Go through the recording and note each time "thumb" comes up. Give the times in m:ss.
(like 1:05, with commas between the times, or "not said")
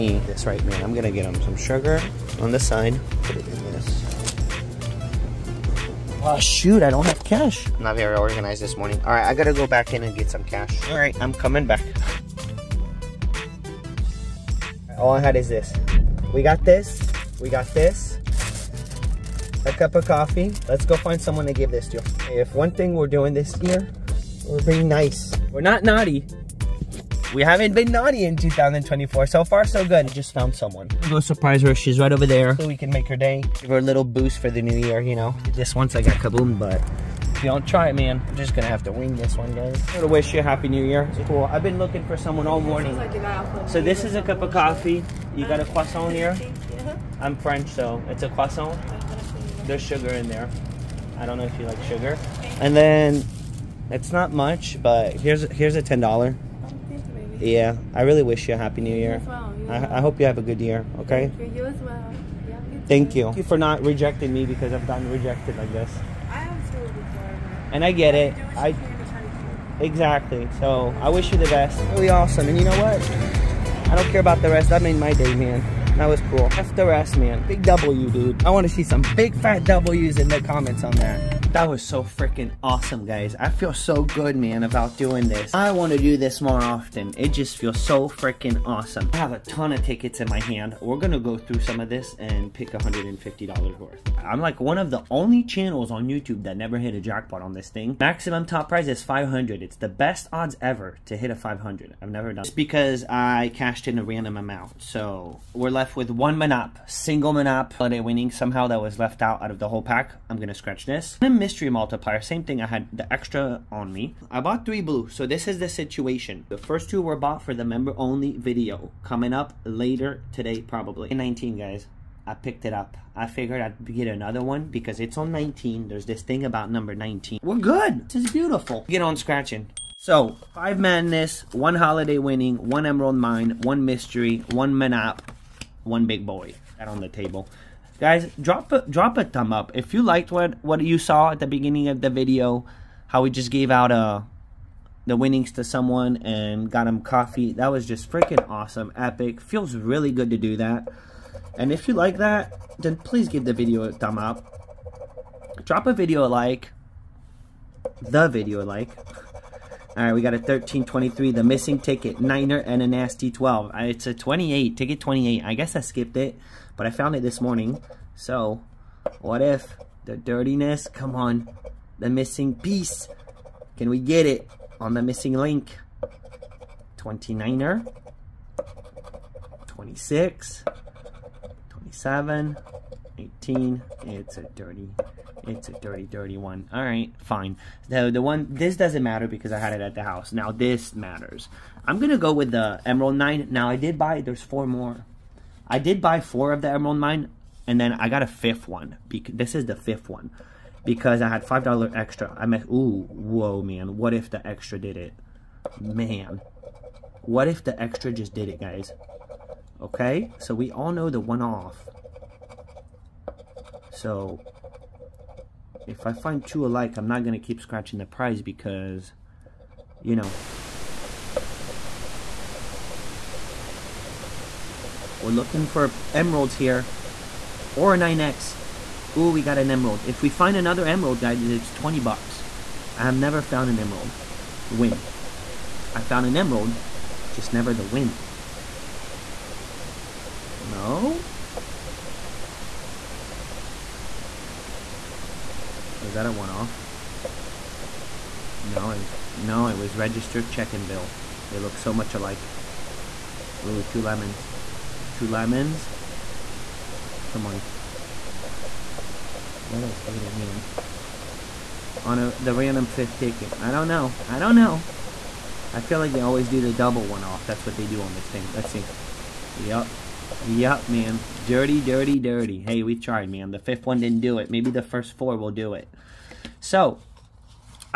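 2:19, 2:33.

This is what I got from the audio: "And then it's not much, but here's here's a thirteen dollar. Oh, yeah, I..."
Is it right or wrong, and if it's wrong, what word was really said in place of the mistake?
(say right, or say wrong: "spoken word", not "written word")
wrong: "ten", not "thirteen".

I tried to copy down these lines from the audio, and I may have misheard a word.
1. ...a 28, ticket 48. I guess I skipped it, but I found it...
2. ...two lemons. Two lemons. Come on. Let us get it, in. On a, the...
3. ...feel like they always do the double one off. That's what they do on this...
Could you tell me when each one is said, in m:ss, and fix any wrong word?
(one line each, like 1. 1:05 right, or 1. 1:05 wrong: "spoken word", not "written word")
1. 2:44 wrong: "28", not "48"
2. 4:13 right
3. 4:25 right.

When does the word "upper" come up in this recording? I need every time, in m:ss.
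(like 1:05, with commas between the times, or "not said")
not said.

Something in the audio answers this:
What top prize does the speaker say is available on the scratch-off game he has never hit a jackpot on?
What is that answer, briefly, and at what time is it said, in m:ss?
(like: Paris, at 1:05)
500, at 1:37.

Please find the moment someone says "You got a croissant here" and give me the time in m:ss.
0:45.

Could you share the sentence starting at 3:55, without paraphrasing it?
I found an emerald, just never the win.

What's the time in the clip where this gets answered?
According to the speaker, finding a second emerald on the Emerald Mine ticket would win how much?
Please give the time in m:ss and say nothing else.
3:51.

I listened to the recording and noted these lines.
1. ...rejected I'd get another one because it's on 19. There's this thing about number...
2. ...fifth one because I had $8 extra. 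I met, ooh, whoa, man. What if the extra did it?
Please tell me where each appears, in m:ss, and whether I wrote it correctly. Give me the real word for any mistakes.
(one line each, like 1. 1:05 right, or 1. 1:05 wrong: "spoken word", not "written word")
1. 2:03 wrong: "figured", not "rejected"
2. 3:19 wrong: "5", not "8".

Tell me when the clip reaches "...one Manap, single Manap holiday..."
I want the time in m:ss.
1:46.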